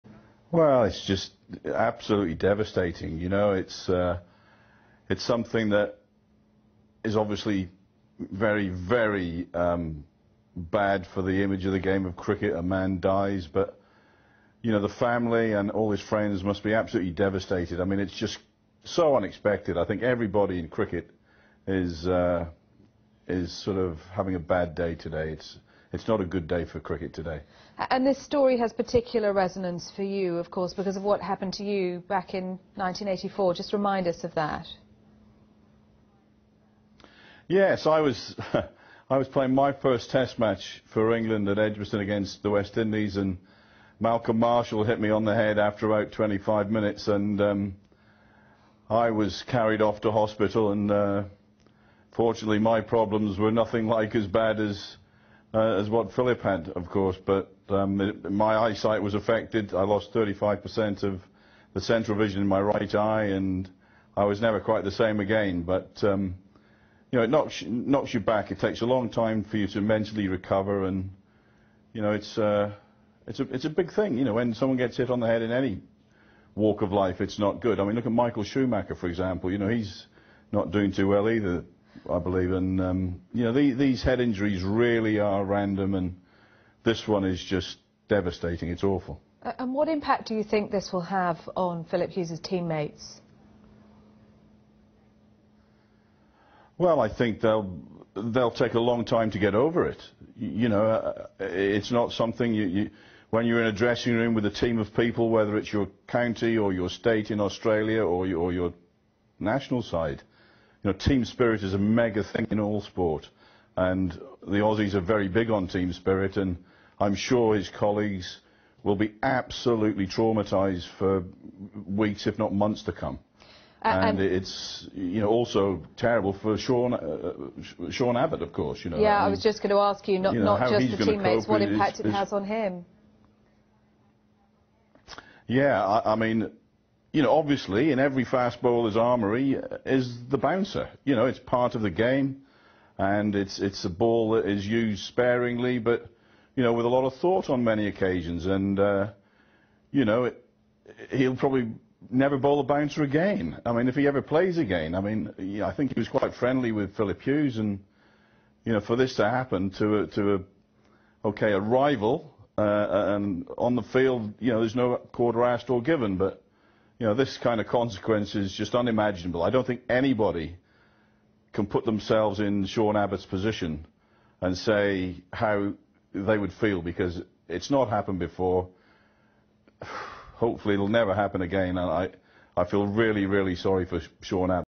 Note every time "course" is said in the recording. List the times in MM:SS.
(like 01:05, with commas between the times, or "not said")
00:30, 00:56, 02:08.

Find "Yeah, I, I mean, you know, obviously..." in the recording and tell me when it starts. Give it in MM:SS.
02:15.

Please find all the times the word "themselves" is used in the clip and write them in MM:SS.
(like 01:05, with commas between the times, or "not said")
02:51.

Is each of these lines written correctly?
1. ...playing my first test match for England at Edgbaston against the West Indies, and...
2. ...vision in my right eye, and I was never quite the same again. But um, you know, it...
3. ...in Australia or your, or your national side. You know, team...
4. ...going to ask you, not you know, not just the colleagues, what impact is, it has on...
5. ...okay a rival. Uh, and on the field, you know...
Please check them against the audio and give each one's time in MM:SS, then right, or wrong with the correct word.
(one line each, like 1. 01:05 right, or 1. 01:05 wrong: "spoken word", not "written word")
1. 00:39 right
2. 01:02 right
3. 01:47 right
4. 02:09 wrong: "teammates", not "colleagues"
5. 02:41 right.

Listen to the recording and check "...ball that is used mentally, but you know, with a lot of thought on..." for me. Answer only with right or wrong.
wrong.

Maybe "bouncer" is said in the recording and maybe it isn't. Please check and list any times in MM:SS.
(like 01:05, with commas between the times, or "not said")
02:20, 02:32.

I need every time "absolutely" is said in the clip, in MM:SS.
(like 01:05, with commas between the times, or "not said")
00:01, 00:16, 01:59.